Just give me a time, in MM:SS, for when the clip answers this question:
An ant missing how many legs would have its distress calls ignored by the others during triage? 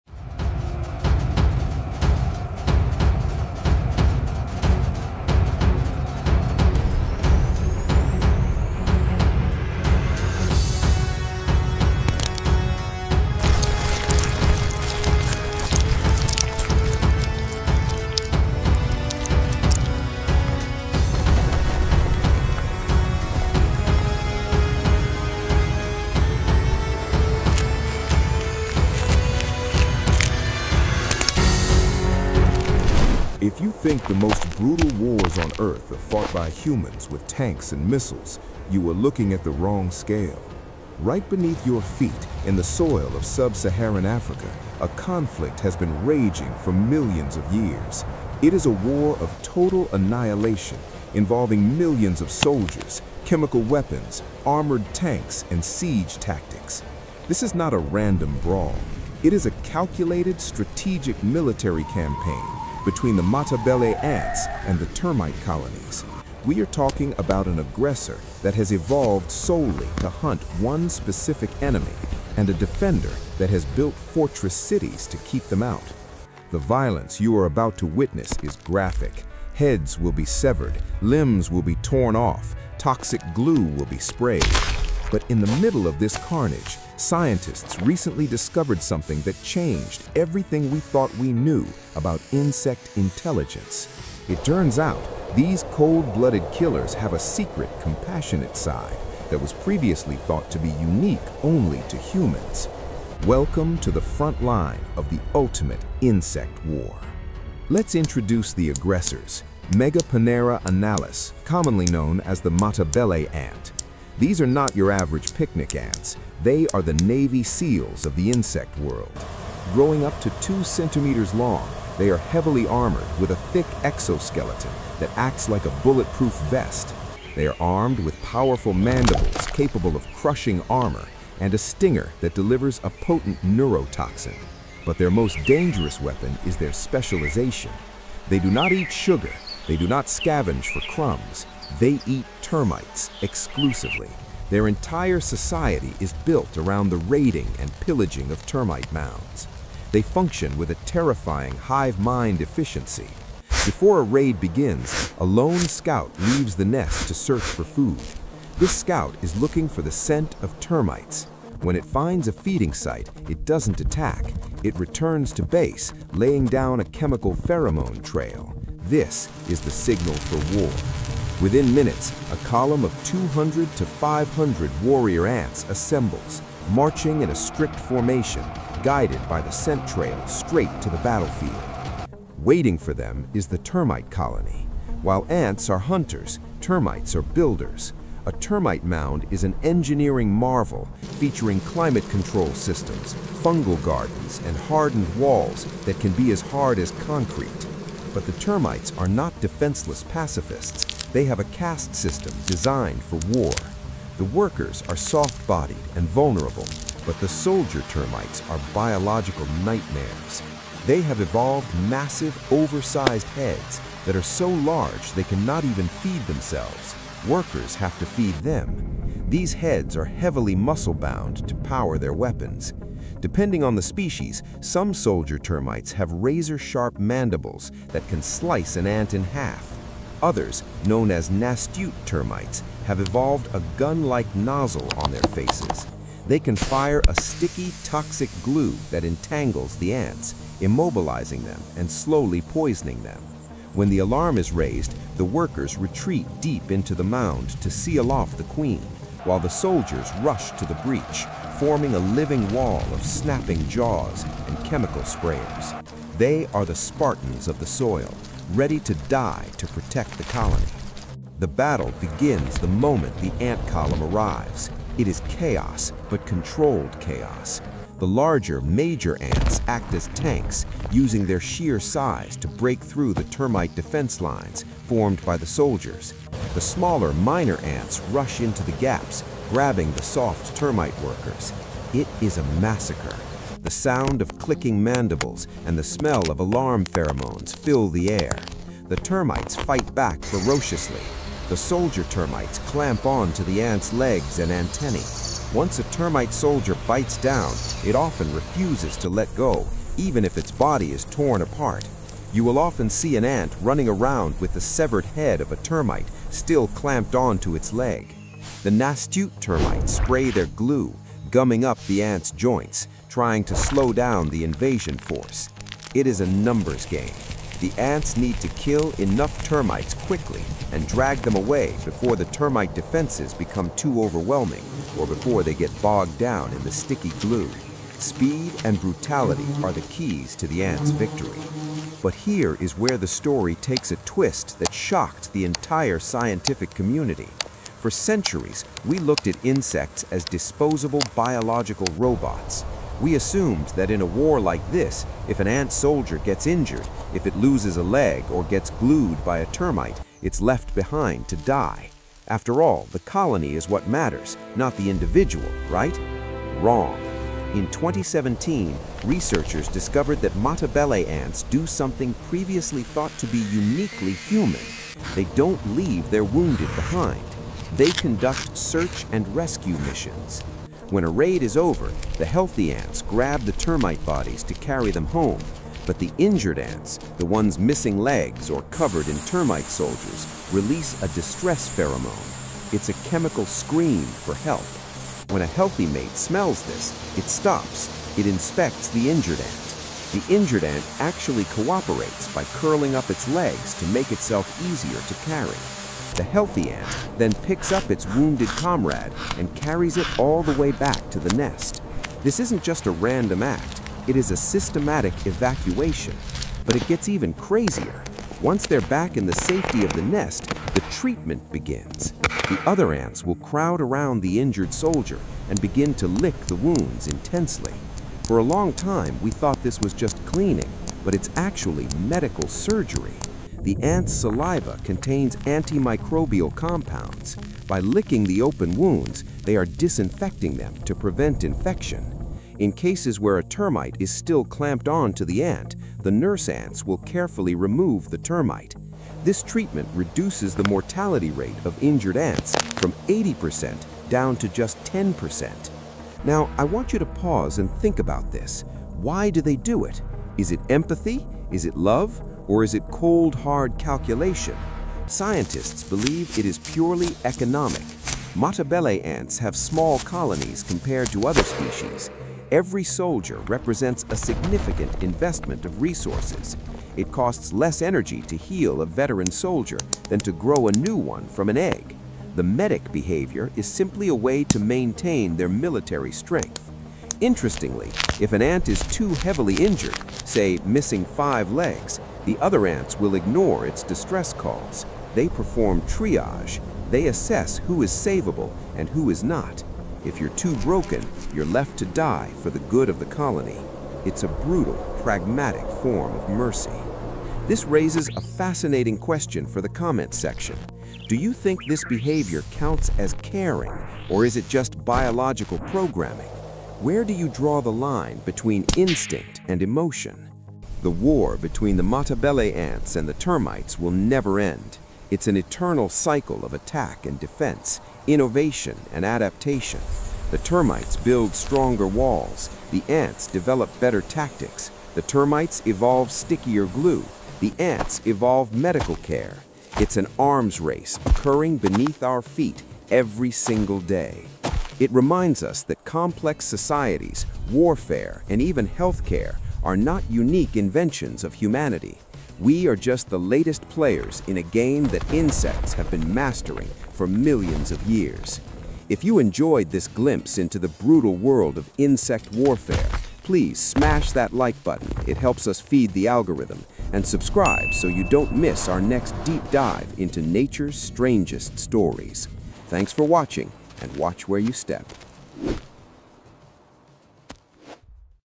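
08:01.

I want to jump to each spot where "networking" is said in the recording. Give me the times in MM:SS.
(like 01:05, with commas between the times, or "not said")
not said.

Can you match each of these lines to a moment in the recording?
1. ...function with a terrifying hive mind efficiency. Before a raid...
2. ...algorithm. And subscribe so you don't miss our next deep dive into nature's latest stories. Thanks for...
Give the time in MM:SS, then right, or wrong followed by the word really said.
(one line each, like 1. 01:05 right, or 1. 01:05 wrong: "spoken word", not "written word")
1. 02:30 right
2. 09:16 wrong: "strangest", not "latest".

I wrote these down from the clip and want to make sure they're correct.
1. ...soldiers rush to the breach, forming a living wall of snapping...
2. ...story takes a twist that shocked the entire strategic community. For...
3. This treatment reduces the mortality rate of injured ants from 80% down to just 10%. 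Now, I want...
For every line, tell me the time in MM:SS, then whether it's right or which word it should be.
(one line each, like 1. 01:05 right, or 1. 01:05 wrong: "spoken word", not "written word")
1. 04:09 right
2. 05:33 wrong: "scientific", not "strategic"
3. 07:19 right.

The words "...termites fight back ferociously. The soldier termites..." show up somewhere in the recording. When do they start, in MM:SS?
04:48.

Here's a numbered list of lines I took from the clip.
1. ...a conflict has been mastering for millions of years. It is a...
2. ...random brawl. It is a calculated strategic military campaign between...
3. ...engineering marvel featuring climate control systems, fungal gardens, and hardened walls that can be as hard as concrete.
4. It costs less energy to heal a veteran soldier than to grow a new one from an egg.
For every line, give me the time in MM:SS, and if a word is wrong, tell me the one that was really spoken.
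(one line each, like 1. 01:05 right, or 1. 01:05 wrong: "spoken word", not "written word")
1. 00:44 wrong: "raging", not "mastering"
2. 00:57 right
3. 03:09 right
4. 07:46 right.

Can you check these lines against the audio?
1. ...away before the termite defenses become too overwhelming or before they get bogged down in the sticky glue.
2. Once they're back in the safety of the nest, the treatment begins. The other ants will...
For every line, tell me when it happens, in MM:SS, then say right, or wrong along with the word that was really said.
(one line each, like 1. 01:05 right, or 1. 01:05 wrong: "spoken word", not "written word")
1. 05:21 right
2. 06:48 right.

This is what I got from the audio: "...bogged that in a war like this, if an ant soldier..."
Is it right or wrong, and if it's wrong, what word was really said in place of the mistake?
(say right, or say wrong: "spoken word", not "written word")
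wrong: "assumed", not "bogged".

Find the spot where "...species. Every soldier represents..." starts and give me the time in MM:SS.
07:41.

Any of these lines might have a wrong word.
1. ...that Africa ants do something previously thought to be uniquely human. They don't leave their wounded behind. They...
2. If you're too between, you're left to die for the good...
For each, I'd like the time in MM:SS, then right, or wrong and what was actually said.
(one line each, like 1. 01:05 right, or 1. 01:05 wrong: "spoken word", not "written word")
1. 06:00 wrong: "Matabele", not "Africa"
2. 08:10 wrong: "broken", not "between".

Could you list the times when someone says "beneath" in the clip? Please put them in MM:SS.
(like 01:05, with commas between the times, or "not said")
00:41, 08:51.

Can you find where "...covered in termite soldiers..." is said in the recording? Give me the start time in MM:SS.
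06:18.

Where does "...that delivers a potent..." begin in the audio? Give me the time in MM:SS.
02:12.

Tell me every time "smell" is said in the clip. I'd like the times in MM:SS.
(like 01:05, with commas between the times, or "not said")
04:45, 06:26.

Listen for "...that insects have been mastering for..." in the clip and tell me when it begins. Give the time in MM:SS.
09:04.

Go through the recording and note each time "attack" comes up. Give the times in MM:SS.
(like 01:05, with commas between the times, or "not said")
02:43, 08:36.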